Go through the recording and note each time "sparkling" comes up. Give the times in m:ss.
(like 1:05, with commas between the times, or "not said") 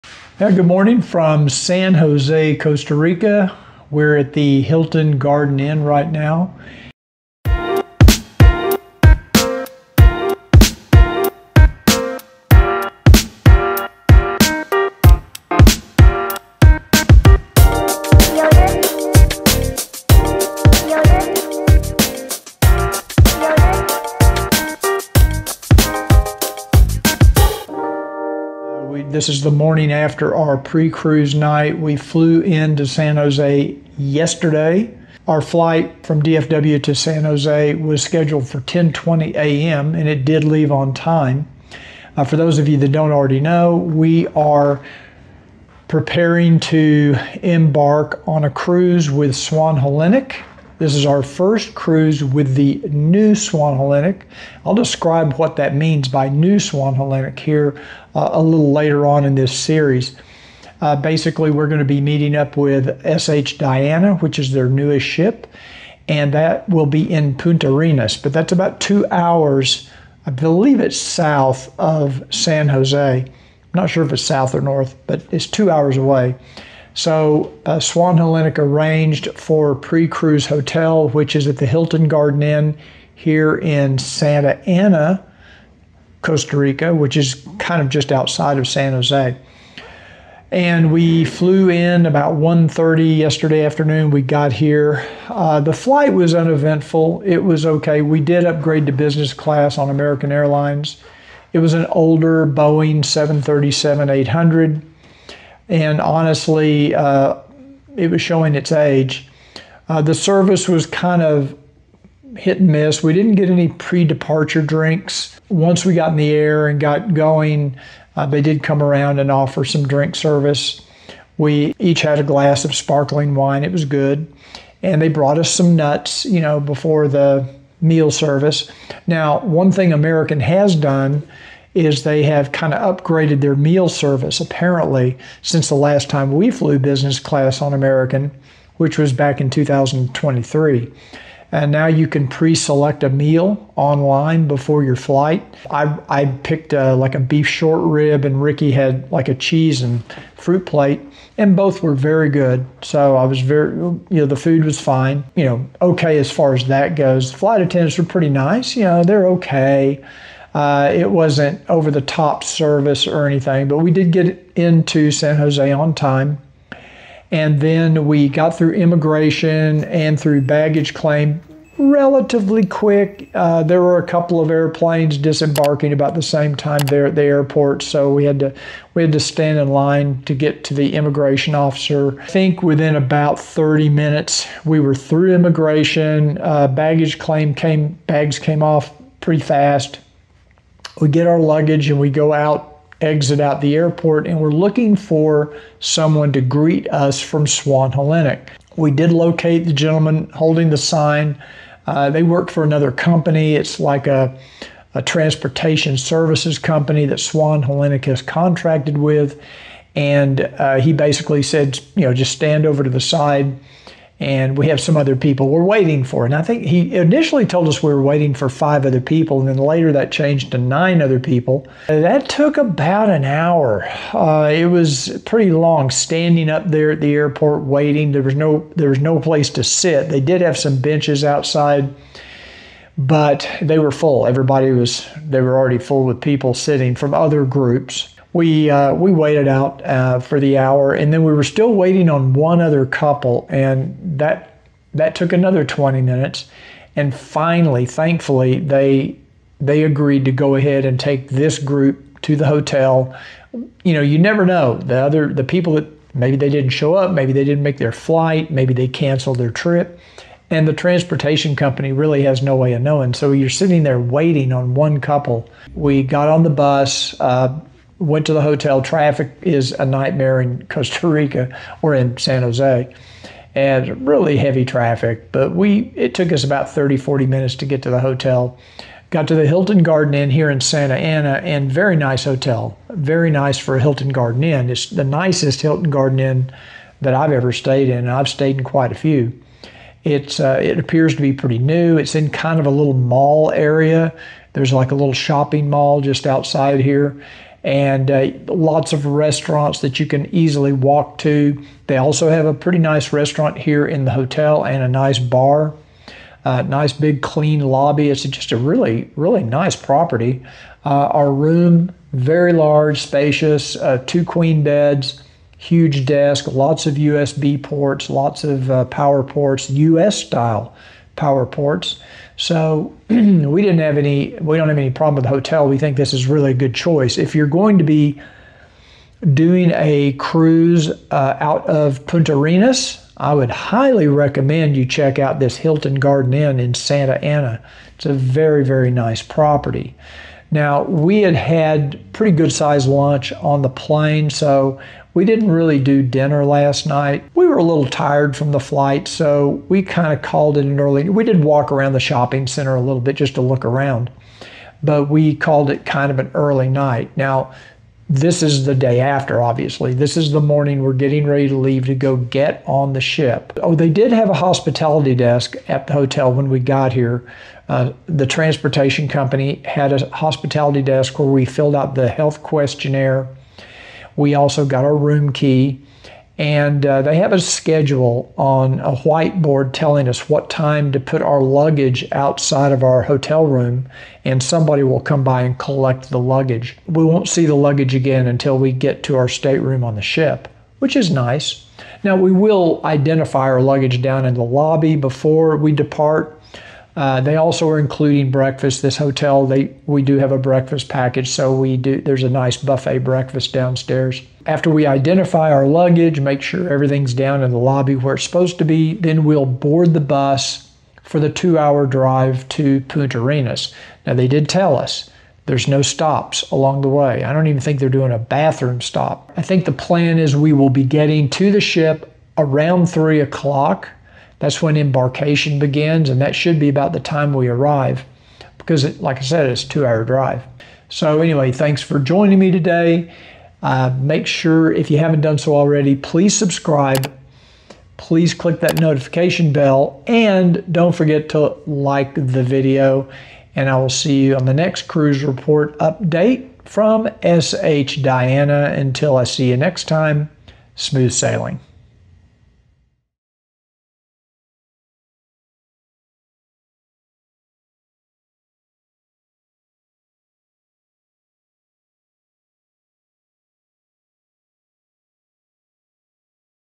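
2:02.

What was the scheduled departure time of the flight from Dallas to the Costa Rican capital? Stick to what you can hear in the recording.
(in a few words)
10:20 a.m.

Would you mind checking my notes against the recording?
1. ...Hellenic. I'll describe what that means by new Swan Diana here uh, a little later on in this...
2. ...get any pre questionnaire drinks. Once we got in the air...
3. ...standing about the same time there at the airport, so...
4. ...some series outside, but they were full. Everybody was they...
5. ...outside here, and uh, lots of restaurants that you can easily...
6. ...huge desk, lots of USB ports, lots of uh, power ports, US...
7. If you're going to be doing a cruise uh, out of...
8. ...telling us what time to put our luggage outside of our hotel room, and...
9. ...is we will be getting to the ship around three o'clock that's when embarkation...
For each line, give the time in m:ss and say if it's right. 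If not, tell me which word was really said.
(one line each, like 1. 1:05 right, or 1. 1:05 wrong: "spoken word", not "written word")
1. 0:53 wrong: "Hellenic", not "Diana"
2. 1:53 wrong: "departure", not "questionnaire"
3. 2:55 wrong: "disembarking", not "standing"
4. 3:50 wrong: "benches", not "series"
5. 4:56 right
6. 5:15 right
7. 5:27 right
8. 6:19 right
9. 7:00 right.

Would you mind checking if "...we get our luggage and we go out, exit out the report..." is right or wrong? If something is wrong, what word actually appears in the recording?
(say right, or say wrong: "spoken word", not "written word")
wrong: "airport", not "report".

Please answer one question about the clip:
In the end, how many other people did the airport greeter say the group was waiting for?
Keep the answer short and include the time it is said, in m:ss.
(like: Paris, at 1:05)
9, at 3:40.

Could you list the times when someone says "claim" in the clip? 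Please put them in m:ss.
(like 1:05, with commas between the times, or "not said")
2:50, 3:07.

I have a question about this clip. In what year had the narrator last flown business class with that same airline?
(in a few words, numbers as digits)
2023.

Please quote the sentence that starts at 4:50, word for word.
It's uh, it appears to be pretty new.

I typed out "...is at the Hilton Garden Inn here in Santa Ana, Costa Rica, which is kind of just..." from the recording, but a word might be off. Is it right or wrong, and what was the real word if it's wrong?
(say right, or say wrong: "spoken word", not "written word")
right.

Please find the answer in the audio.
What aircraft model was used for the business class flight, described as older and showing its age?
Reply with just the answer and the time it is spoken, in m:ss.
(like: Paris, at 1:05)
Boeing 737 800, at 1:42.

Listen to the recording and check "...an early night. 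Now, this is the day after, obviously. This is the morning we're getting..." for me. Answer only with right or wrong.
right.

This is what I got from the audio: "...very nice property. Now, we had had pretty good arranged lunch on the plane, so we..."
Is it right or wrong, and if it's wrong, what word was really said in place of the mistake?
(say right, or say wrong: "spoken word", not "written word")
wrong: "sized", not "arranged".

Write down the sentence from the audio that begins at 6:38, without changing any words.
This hotel, they we do have a breakfast package, so we do.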